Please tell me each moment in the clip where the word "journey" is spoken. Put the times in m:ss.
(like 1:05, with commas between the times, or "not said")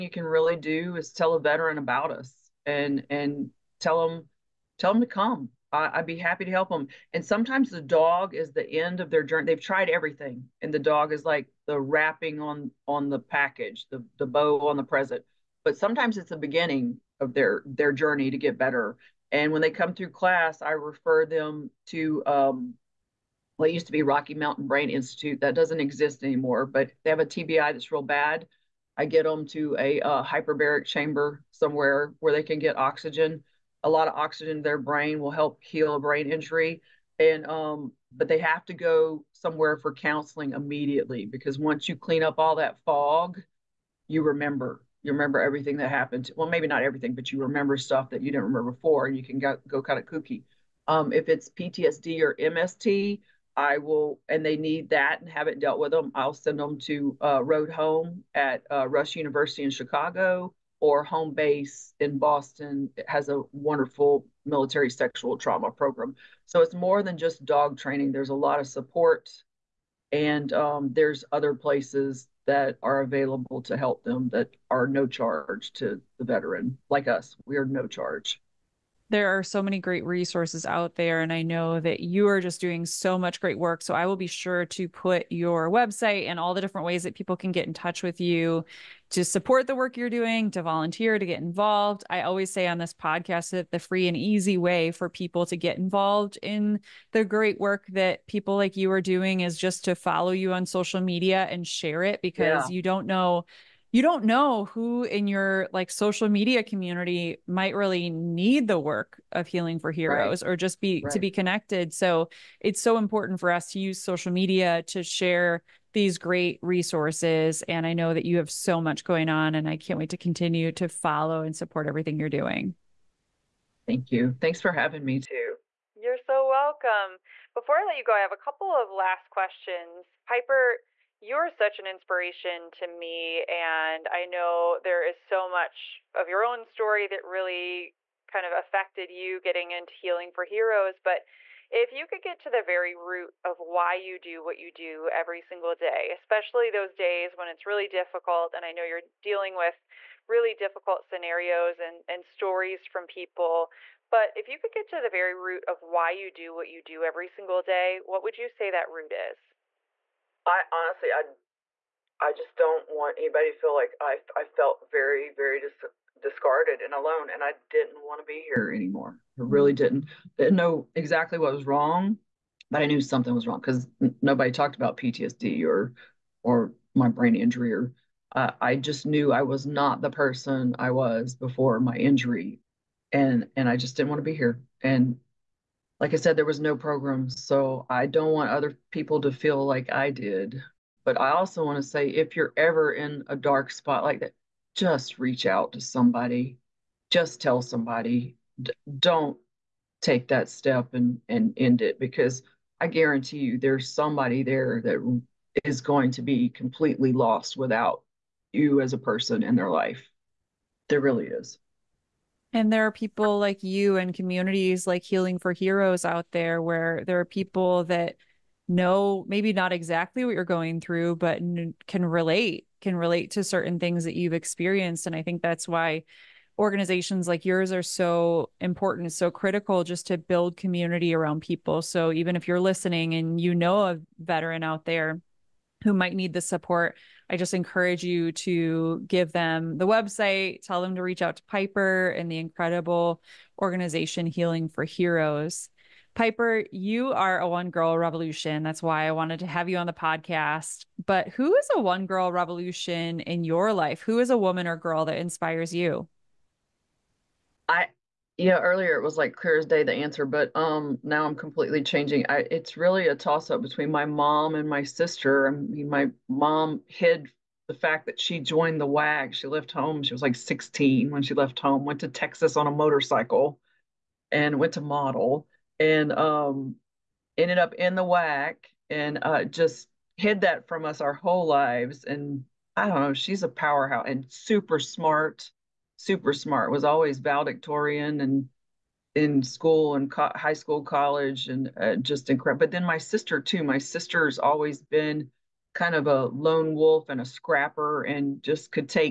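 0:09, 0:17.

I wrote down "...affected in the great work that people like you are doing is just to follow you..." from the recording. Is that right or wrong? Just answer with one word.
wrong.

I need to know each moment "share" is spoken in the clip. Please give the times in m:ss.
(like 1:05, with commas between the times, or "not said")
1:41, 1:55.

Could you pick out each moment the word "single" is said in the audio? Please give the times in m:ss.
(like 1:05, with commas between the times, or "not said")
2:25, 2:37.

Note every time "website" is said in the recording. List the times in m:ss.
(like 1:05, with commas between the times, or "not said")
1:25, 3:59.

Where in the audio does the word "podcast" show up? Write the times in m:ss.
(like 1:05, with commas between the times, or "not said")
1:32, 4:09.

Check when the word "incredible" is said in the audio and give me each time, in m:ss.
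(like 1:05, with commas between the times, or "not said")
4:02, 4:52.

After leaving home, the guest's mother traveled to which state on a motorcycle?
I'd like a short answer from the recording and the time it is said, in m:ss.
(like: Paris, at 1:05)
Texas, at 4:32.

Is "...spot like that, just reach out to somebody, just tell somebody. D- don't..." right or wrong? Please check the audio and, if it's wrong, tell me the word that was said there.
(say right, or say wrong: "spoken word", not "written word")
right.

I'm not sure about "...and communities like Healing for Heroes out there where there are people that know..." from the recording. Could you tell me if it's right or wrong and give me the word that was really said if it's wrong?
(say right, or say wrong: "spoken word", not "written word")
right.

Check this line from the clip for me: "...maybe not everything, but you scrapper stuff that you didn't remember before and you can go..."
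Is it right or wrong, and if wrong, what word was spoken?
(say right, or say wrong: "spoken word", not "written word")
wrong: "remember", not "scrapper".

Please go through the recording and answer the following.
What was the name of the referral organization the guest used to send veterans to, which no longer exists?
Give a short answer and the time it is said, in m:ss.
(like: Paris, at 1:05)
Rocky Mountain Brain Institute, at 0:24.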